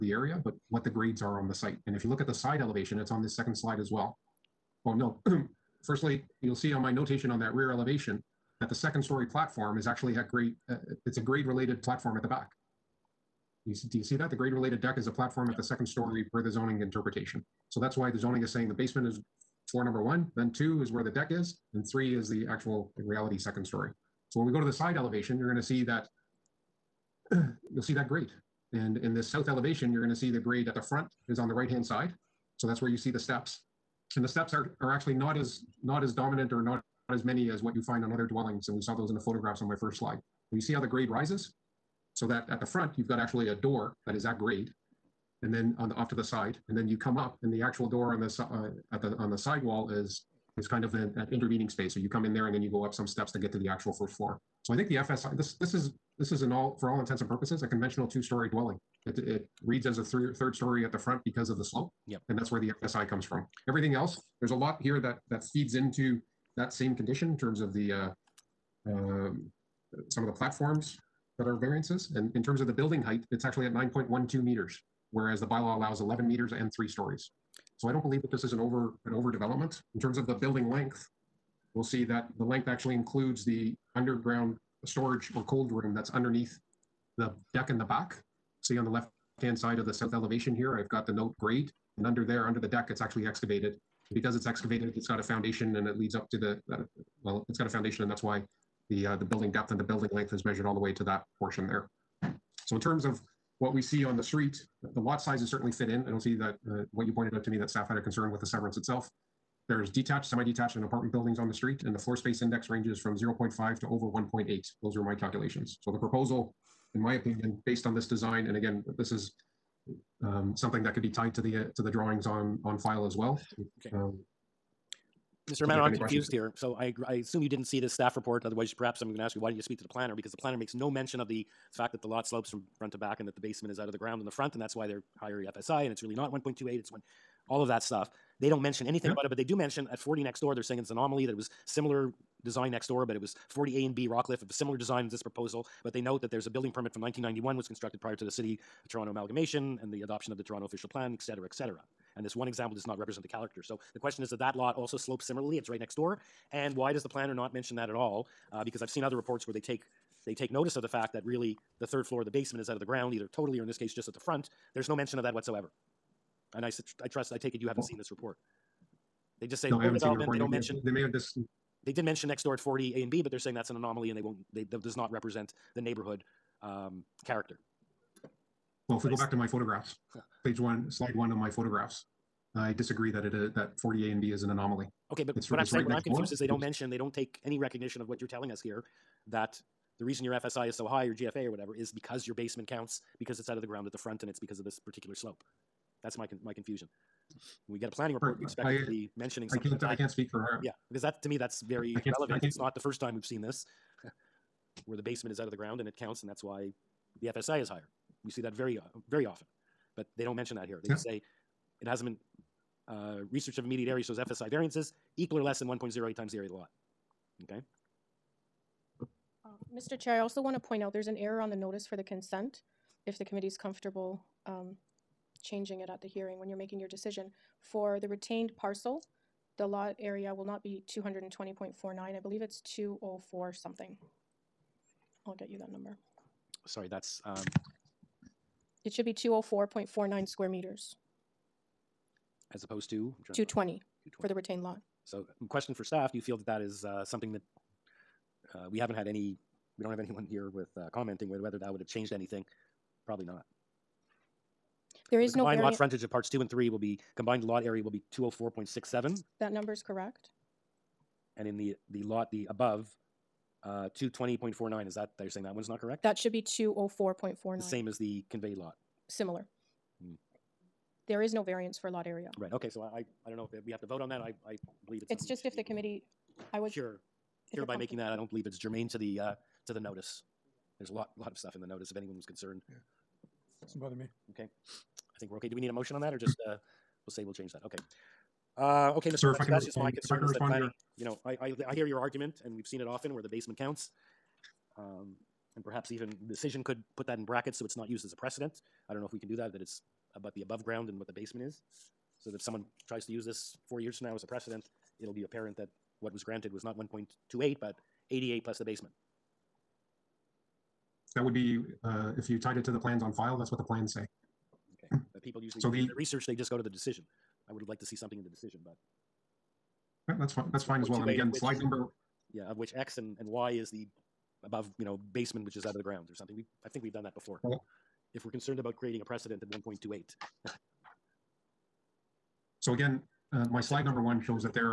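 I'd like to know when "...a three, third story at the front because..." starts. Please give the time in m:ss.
0:59.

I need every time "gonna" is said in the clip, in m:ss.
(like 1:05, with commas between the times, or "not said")
0:25, 0:30.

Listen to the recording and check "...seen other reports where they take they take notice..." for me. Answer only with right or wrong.
right.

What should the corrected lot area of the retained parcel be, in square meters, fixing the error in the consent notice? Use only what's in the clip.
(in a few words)
204.49.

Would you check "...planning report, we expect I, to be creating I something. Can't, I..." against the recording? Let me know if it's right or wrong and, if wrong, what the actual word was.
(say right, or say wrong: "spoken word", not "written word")
wrong: "mentioning", not "creating".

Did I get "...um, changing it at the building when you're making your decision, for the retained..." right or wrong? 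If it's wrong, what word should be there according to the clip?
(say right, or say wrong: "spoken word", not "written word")
wrong: "hearing", not "building".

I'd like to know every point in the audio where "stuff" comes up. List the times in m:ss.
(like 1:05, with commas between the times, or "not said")
2:17, 4:41.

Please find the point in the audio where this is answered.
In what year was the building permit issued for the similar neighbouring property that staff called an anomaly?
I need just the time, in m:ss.
2:27.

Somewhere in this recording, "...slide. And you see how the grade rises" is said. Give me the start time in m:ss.
0:39.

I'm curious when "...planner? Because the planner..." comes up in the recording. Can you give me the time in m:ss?
2:09.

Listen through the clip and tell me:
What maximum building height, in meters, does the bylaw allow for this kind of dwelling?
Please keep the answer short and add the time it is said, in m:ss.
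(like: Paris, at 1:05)
11 meters, at 1:15.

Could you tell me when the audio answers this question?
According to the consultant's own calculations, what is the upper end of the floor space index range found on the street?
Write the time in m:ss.
1:53.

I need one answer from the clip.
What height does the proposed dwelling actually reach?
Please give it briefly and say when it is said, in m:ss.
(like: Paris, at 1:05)
9.12 meters, at 1:13.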